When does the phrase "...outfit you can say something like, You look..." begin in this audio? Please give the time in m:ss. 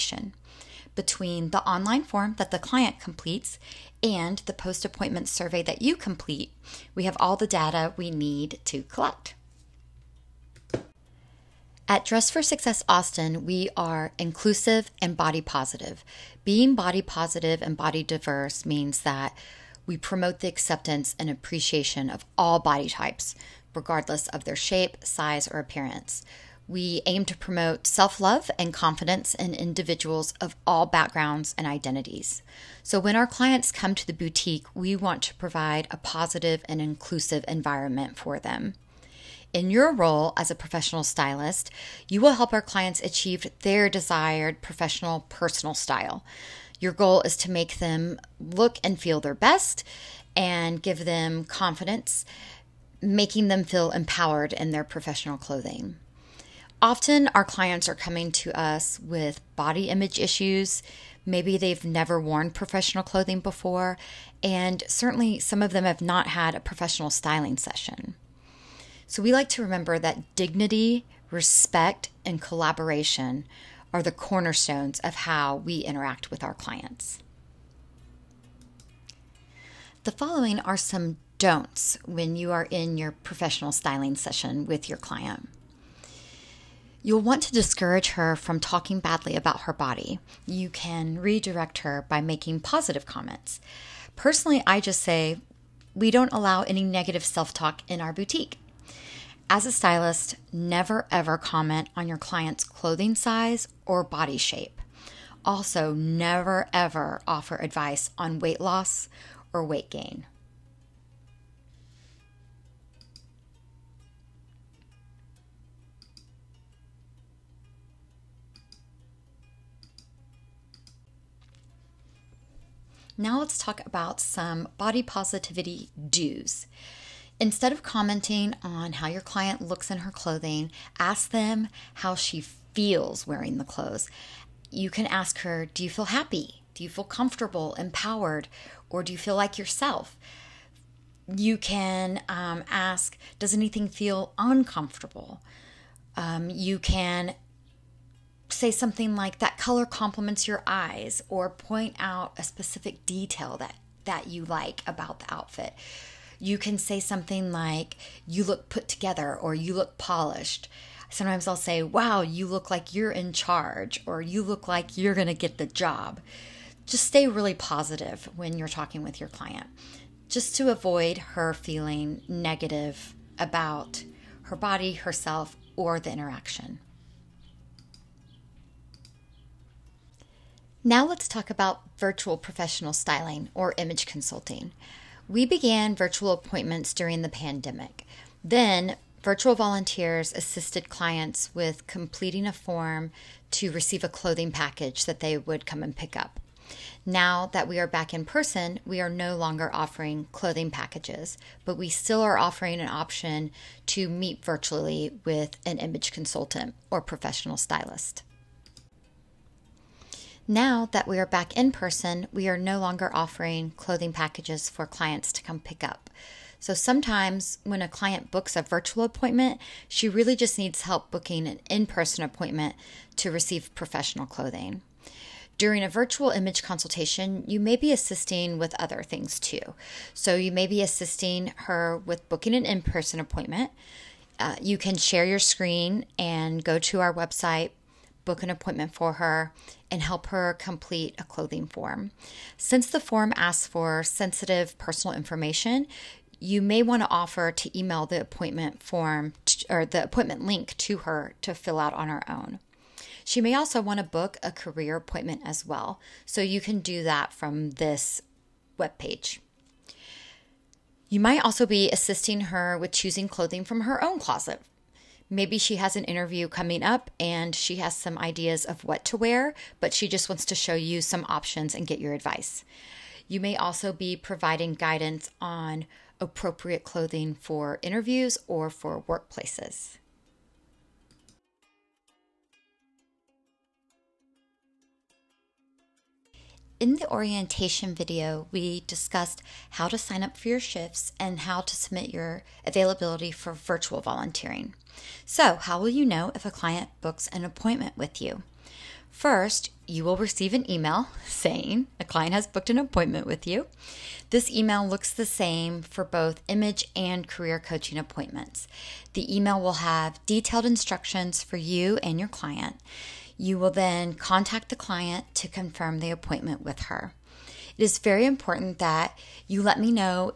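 2:35.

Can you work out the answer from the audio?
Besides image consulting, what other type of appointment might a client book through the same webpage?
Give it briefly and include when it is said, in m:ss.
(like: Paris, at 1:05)
career appointment, at 4:14.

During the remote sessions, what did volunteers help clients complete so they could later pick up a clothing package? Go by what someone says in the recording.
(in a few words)
a form.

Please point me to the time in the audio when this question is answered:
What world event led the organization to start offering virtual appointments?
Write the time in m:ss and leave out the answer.
3:07.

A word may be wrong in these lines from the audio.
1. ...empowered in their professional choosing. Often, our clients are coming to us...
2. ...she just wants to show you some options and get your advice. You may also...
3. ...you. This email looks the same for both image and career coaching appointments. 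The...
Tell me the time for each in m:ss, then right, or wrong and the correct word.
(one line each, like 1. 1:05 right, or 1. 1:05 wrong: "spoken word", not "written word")
1. 0:53 wrong: "clothing", not "choosing"
2. 4:29 right
3. 5:03 right.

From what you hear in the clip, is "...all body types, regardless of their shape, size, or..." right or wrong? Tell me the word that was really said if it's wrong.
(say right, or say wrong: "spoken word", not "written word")
right.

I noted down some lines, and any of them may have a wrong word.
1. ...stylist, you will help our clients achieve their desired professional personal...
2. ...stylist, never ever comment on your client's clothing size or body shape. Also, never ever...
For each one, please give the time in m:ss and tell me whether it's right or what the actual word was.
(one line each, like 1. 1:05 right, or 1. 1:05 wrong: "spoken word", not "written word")
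1. 0:41 right
2. 1:39 right.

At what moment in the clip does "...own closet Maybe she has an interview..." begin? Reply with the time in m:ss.
4:24.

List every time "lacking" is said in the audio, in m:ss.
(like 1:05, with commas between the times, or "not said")
not said.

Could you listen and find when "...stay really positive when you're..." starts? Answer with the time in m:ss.
2:47.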